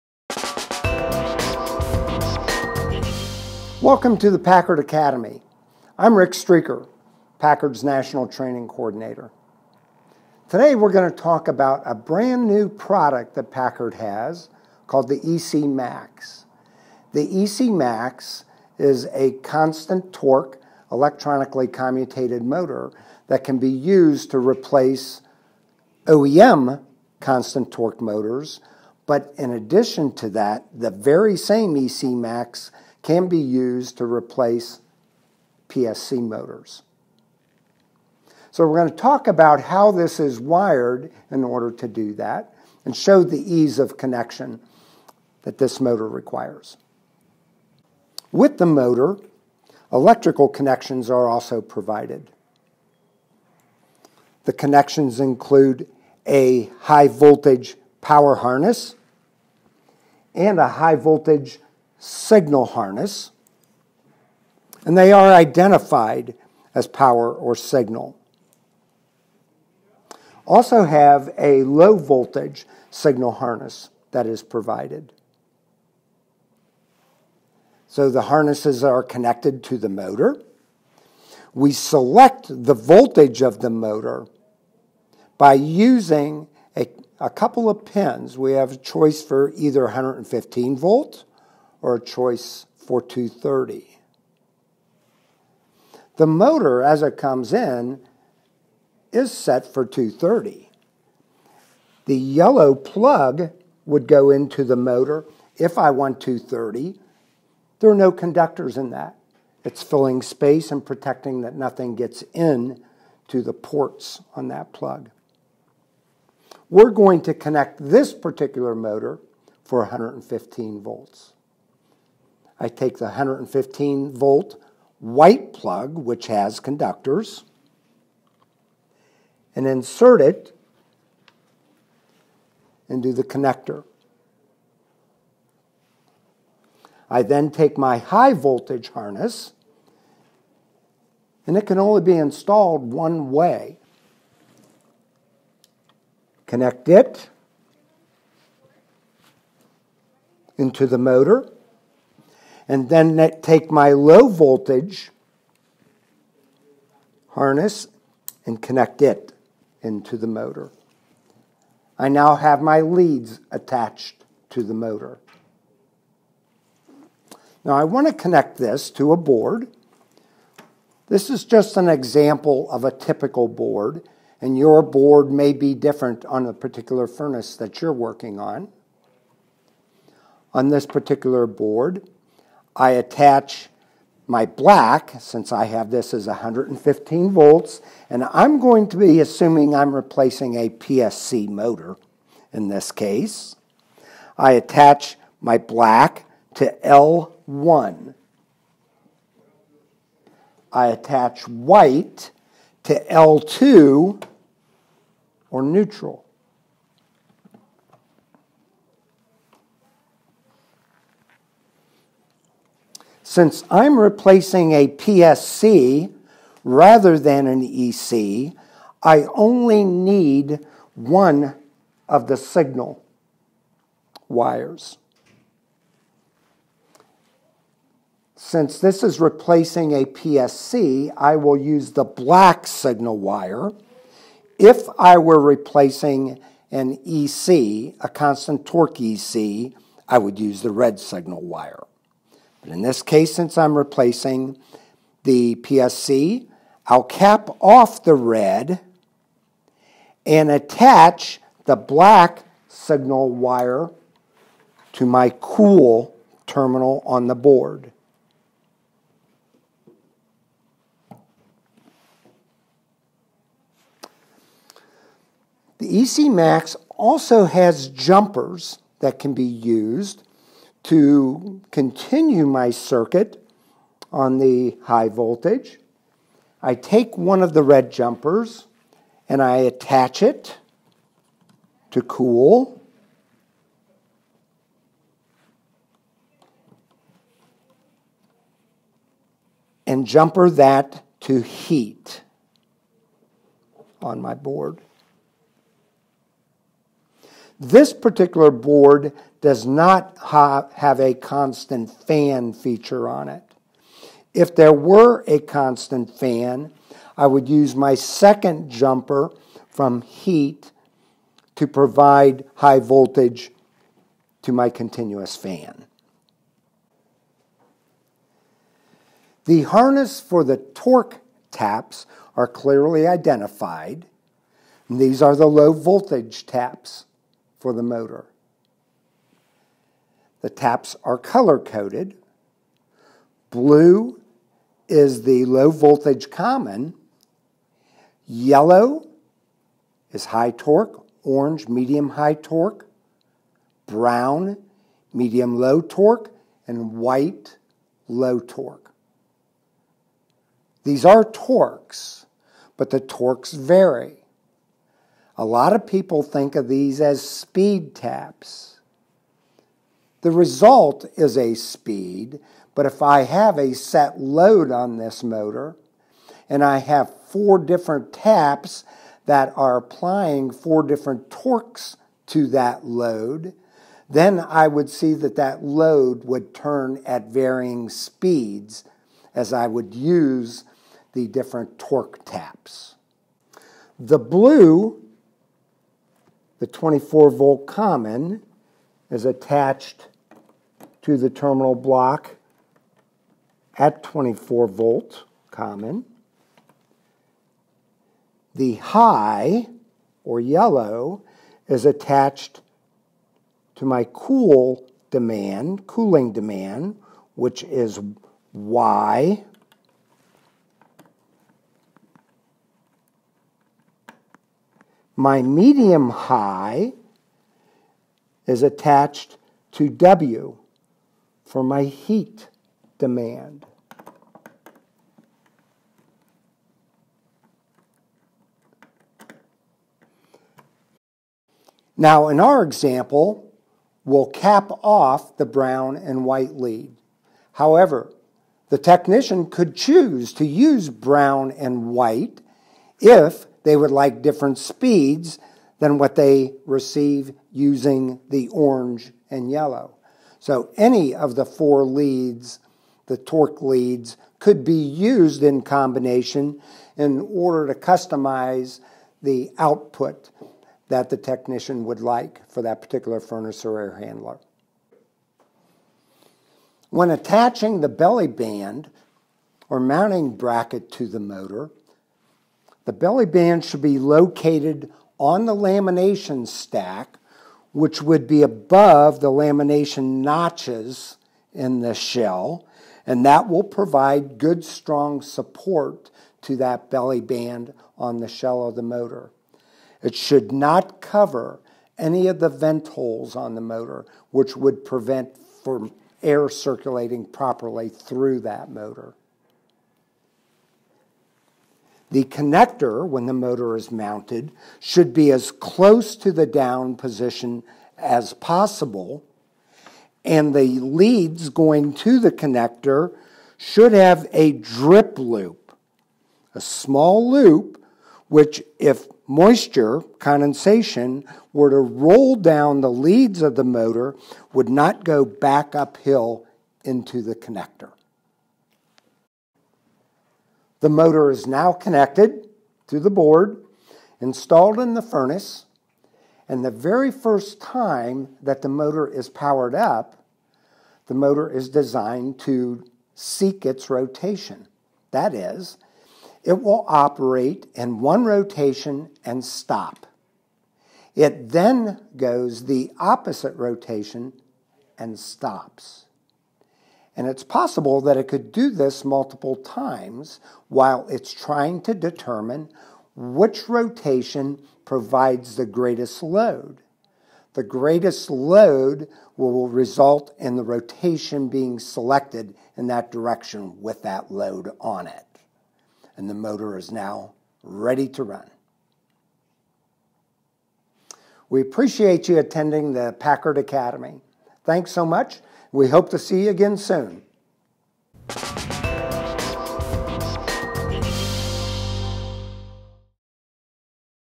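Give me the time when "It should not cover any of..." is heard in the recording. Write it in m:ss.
8:10.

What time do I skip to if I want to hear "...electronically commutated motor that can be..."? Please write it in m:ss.
0:20.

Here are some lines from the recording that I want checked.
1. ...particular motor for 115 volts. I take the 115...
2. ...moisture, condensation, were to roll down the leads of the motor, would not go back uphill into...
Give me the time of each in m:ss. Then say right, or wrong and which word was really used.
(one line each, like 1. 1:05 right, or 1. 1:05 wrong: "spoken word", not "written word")
1. 1:58 right
2. 8:39 right.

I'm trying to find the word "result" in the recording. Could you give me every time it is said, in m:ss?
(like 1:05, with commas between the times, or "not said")
6:00, 9:29.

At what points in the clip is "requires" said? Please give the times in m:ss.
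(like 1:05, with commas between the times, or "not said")
0:46.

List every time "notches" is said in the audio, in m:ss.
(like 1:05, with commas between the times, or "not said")
8:00.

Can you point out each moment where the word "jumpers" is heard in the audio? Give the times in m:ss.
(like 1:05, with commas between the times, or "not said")
4:27, 4:37, 4:50, 5:08.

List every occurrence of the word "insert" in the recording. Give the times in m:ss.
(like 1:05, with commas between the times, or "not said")
2:09.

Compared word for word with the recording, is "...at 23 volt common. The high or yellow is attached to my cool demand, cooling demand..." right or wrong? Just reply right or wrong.
wrong.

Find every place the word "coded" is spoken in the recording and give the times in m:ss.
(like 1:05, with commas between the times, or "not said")
5:31.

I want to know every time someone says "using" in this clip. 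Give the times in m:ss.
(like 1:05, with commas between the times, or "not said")
1:25, 7:27.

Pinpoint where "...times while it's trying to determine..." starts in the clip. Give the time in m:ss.
9:19.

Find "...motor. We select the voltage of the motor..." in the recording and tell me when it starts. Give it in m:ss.
1:19.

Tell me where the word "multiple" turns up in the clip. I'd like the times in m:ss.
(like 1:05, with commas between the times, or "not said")
9:19.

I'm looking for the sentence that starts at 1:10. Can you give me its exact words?
Also, have a low voltage signal harness that is provided.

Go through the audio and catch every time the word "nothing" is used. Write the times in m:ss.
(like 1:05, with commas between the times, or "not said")
1:51.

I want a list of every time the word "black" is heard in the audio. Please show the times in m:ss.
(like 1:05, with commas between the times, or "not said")
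3:04, 3:15, 3:52, 4:11.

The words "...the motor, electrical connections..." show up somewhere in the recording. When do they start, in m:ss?
0:48.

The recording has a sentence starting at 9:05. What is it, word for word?
That is, it will operate in one rotation and stop.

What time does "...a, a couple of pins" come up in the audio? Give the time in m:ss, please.
1:26.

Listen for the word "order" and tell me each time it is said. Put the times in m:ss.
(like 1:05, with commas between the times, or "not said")
0:41, 7:37.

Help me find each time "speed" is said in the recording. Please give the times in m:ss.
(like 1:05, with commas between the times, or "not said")
5:57, 6:01, 6:17, 7:24.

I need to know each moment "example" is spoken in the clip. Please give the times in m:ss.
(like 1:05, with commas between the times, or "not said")
2:51, 7:12.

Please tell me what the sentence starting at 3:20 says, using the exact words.
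I attach white to L2 or neutral.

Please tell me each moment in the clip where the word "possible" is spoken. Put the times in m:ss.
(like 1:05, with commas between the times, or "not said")
8:28, 9:17.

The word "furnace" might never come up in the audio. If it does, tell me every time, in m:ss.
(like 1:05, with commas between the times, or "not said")
2:57, 7:43, 8:55.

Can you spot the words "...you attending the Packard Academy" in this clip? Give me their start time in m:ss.
9:42.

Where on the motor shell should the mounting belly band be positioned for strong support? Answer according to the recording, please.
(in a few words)
Lamination stack.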